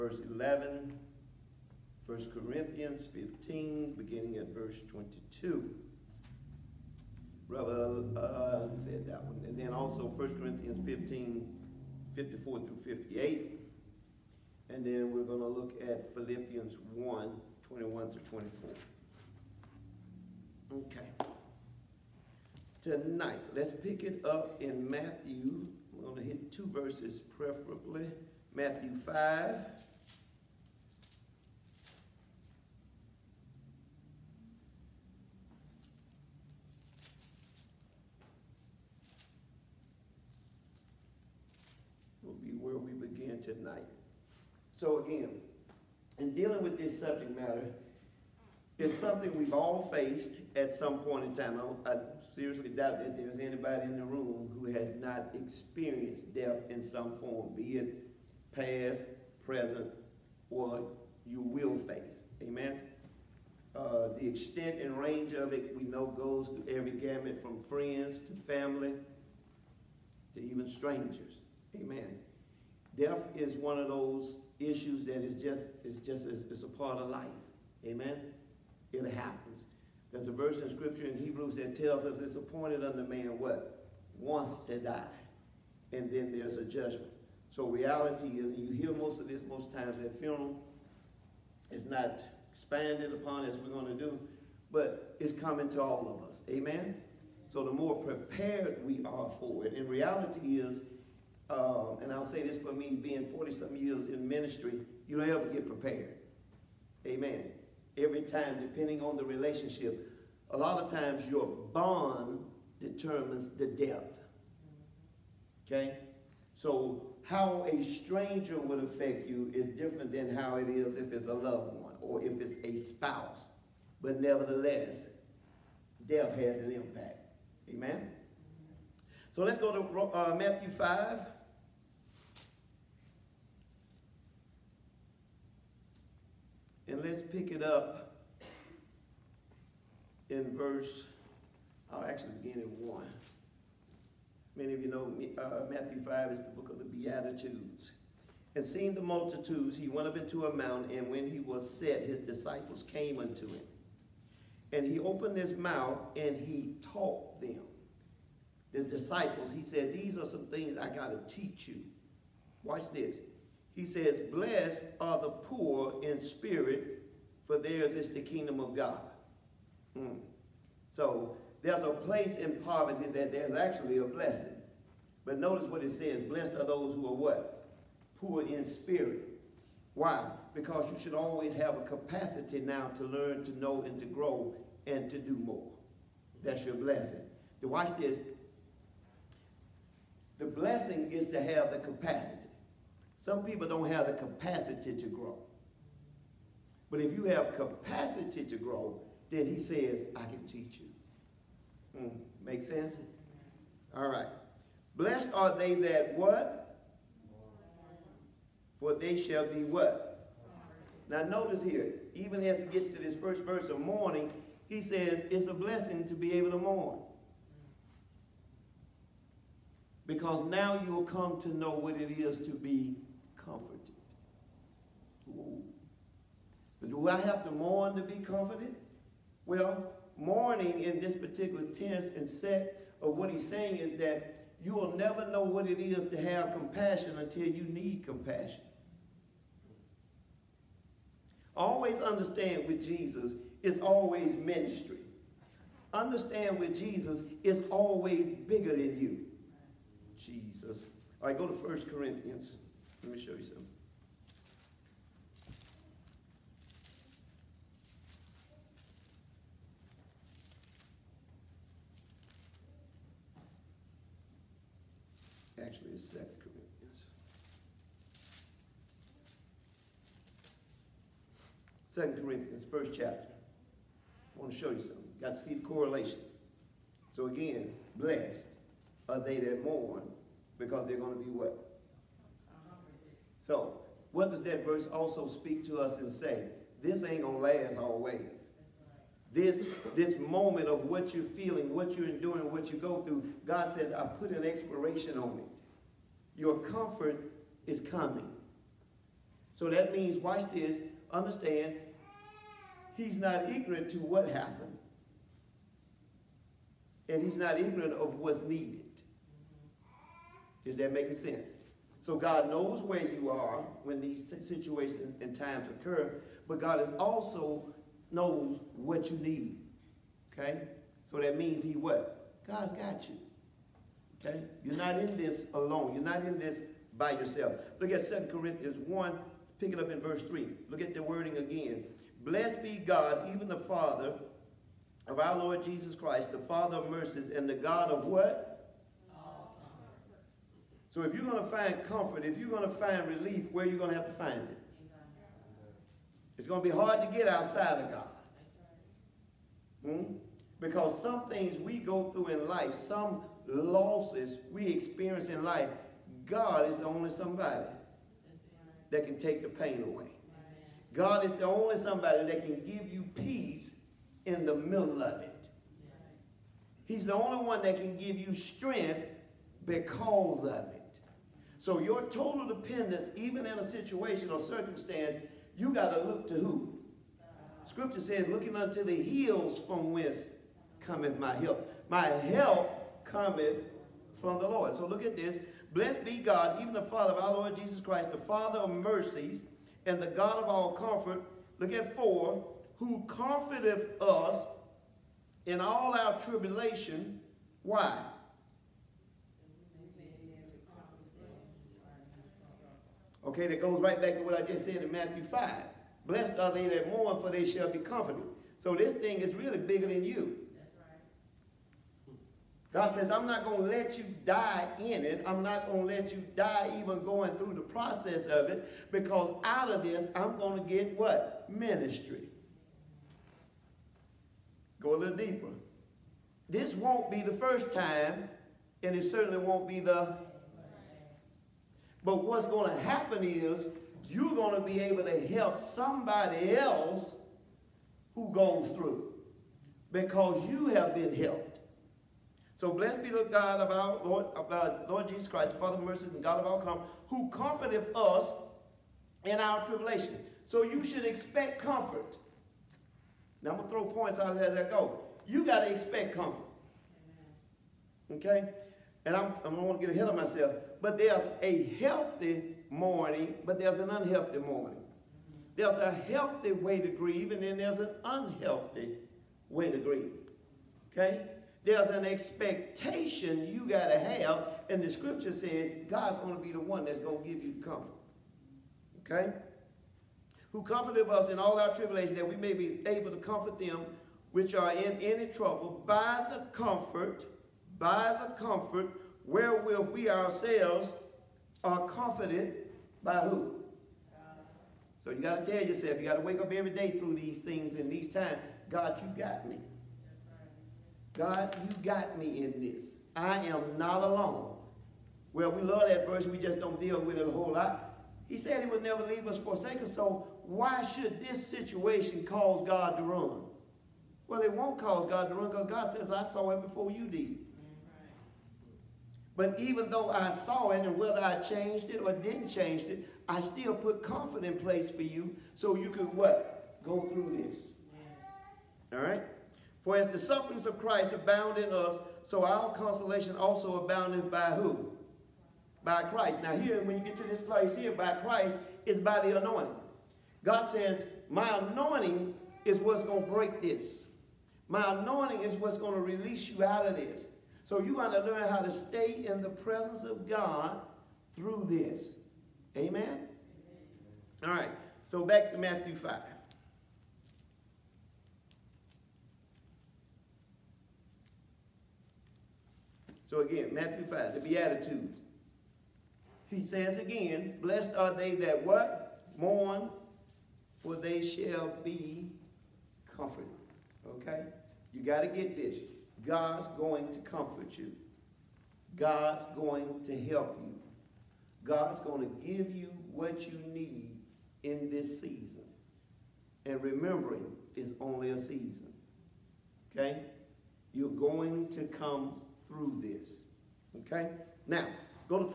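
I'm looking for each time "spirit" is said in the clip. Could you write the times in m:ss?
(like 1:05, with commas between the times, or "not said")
2:46, 2:58.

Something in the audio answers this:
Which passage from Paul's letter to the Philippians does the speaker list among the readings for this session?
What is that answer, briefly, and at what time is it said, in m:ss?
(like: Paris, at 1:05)
Philippians 1:21-24, at 0:16.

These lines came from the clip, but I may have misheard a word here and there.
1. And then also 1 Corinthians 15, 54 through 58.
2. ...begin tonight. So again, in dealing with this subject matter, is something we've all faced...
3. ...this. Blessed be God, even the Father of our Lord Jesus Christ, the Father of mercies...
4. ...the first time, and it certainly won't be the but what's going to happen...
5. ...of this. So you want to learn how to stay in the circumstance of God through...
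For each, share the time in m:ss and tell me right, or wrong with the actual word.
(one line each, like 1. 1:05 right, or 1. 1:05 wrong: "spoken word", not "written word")
1. 0:09 right
2. 0:42 right
3. 6:25 right
4. 7:07 right
5. 9:06 wrong: "presence", not "circumstance".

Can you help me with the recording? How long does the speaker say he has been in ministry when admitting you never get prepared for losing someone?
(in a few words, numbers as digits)
40-something years.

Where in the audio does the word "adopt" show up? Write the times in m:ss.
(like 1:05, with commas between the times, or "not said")
not said.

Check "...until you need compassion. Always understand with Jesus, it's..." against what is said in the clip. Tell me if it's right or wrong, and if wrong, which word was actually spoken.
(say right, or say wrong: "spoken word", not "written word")
right.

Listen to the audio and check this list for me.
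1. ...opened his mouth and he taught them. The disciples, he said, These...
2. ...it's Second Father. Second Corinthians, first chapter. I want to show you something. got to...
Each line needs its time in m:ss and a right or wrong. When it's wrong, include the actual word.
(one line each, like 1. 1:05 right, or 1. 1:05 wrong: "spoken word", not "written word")
1. 2:34 right
2. 4:25 wrong: "Corinthians", not "Father".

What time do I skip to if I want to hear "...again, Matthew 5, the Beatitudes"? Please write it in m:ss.
9:23.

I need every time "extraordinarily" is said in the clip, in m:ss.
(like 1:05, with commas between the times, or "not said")
not said.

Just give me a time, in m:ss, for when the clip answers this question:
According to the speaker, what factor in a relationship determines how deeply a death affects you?
1:51.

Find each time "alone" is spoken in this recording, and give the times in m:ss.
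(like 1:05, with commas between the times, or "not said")
5:25, 8:24.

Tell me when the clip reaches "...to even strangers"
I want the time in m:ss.
1:10.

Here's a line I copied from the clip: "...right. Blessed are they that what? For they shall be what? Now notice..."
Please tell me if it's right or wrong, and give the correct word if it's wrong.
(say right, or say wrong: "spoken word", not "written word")
right.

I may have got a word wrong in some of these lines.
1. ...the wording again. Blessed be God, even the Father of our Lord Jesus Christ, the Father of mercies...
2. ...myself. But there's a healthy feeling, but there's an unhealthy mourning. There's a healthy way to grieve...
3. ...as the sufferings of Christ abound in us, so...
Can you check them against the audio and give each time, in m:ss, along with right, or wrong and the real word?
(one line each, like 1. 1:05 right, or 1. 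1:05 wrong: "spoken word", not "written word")
1. 5:30 right
2. 7:40 wrong: "mourning", not "feeling"
3. 8:49 right.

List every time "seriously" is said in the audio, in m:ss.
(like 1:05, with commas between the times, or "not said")
0:52.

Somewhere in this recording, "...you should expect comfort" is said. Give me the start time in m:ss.
7:30.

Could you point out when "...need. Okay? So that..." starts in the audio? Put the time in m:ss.
5:19.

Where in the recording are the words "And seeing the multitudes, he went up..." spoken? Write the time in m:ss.
2:28.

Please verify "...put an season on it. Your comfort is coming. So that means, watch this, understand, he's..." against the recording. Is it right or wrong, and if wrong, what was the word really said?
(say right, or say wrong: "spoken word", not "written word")
wrong: "expiration", not "season".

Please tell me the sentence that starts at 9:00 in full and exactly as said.
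God says, my anointing is what's going to break this.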